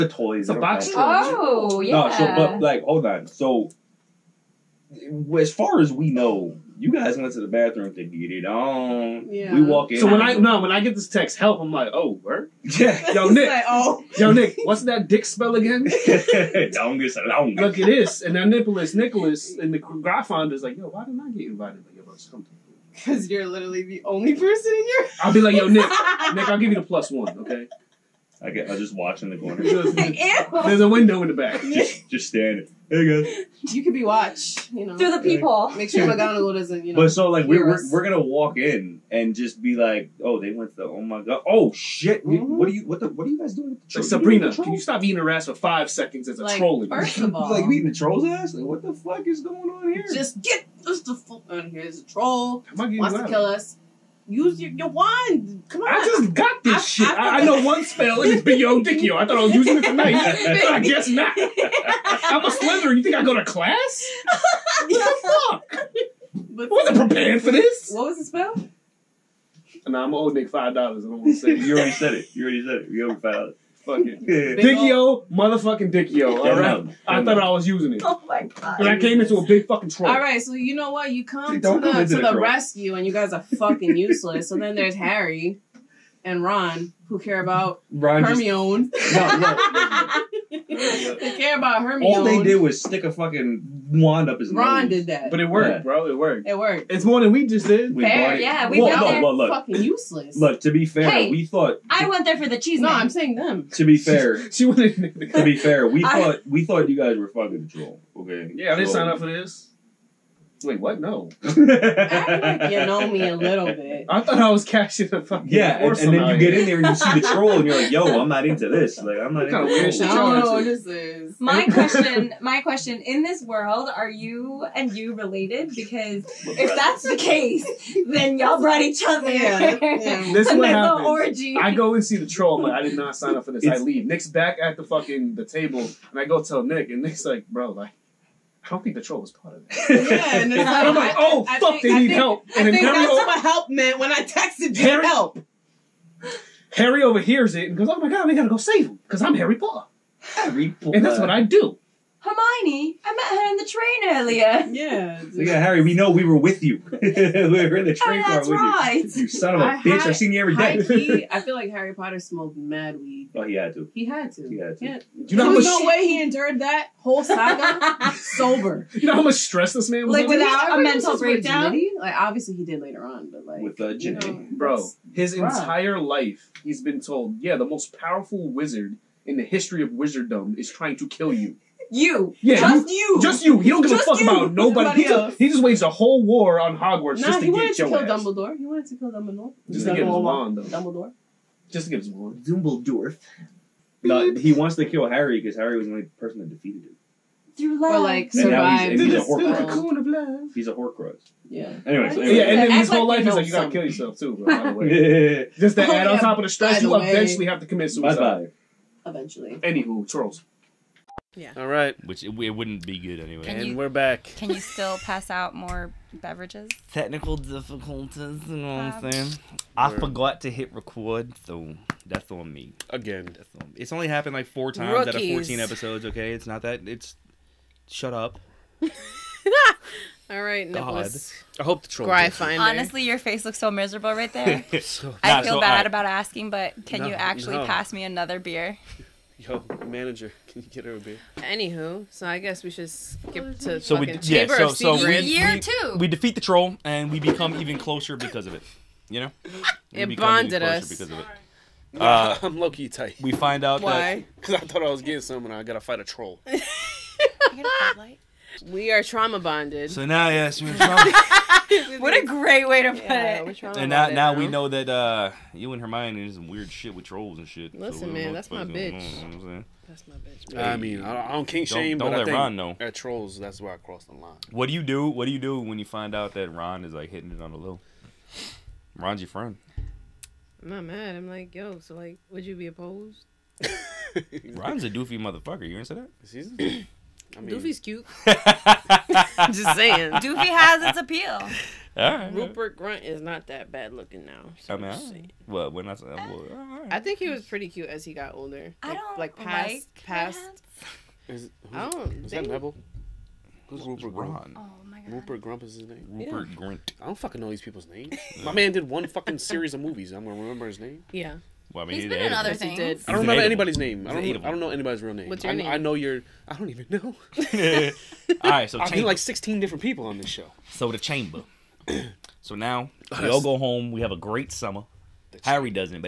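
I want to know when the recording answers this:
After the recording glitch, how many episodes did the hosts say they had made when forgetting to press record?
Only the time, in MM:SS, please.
03:45.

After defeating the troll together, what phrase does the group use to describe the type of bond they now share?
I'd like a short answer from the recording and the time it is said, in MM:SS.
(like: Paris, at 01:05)
trauma bonded, at 04:19.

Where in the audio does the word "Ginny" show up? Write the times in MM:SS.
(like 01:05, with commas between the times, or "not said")
02:53.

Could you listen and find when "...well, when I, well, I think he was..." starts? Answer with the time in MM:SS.
04:55.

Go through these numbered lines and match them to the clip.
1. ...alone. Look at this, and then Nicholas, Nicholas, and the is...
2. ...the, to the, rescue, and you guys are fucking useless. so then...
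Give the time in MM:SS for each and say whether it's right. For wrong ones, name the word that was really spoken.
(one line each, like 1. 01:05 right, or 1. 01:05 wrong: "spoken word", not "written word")
1. 00:17 right
2. 01:21 right.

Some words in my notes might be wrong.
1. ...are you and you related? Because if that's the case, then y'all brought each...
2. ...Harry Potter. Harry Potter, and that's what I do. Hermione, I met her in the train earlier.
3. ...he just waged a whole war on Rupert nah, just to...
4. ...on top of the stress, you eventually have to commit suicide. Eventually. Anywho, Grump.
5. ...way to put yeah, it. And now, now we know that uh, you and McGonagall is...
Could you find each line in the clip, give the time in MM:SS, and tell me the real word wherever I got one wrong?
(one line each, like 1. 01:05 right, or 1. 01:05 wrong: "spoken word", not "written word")
1. 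02:03 right
2. 02:29 right
3. 03:05 wrong: "Hogwarts", not "Rupert"
4. 03:26 wrong: "Charles", not "Grump"
5. 04:22 wrong: "Hermione", not "McGonagall".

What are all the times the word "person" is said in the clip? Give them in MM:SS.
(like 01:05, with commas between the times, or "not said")
00:24, 03:16.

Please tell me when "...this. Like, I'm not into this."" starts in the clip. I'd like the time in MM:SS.
01:58.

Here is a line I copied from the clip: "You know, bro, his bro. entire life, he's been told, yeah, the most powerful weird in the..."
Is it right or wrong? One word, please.
wrong.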